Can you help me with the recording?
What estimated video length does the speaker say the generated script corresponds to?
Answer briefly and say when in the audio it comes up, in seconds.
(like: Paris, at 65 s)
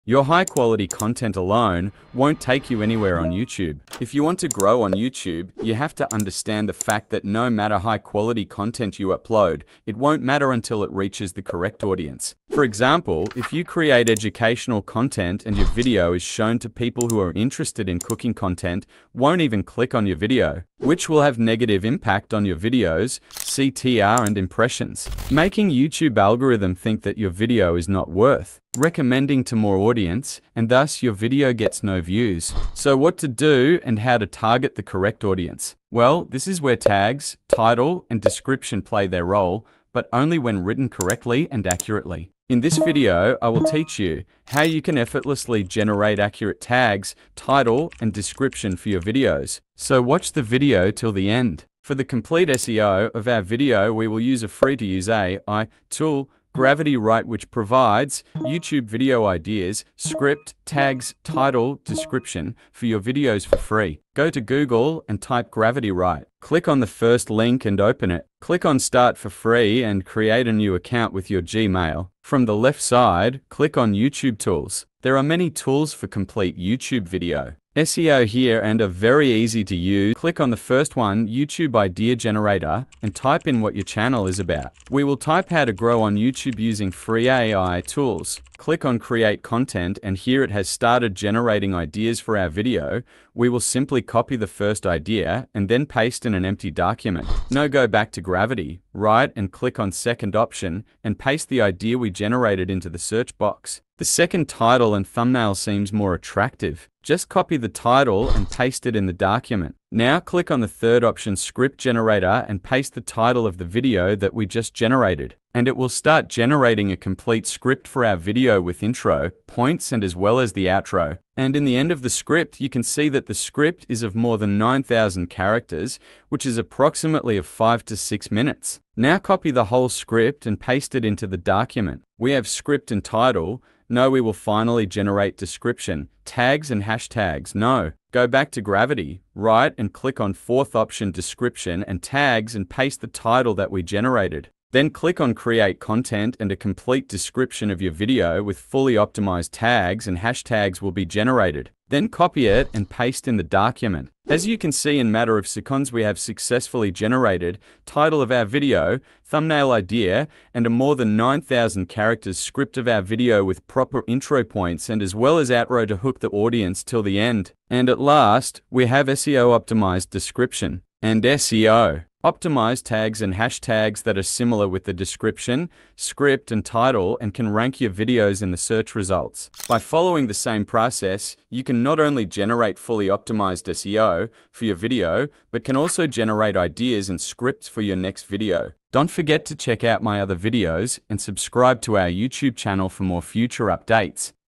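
5 to 6 minutes, at 127 s.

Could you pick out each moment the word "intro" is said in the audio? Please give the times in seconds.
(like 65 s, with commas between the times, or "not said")
118 s, 164 s.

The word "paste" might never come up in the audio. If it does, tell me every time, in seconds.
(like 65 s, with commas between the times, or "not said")
95 s, 101 s, 108 s, 112 s, 130 s, 142 s, 152 s.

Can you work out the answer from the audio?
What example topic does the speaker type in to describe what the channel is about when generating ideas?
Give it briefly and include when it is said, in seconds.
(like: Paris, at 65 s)
how to grow on YouTube using free AI tools, at 85 s.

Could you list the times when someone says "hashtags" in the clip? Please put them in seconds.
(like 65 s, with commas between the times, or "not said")
136 s, 150 s, 173 s.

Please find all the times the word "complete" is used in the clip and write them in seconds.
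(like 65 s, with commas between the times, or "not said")
52 s, 76 s, 116 s, 146 s.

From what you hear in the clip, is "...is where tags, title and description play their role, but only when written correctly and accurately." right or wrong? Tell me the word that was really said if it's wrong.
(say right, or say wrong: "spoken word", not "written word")
right.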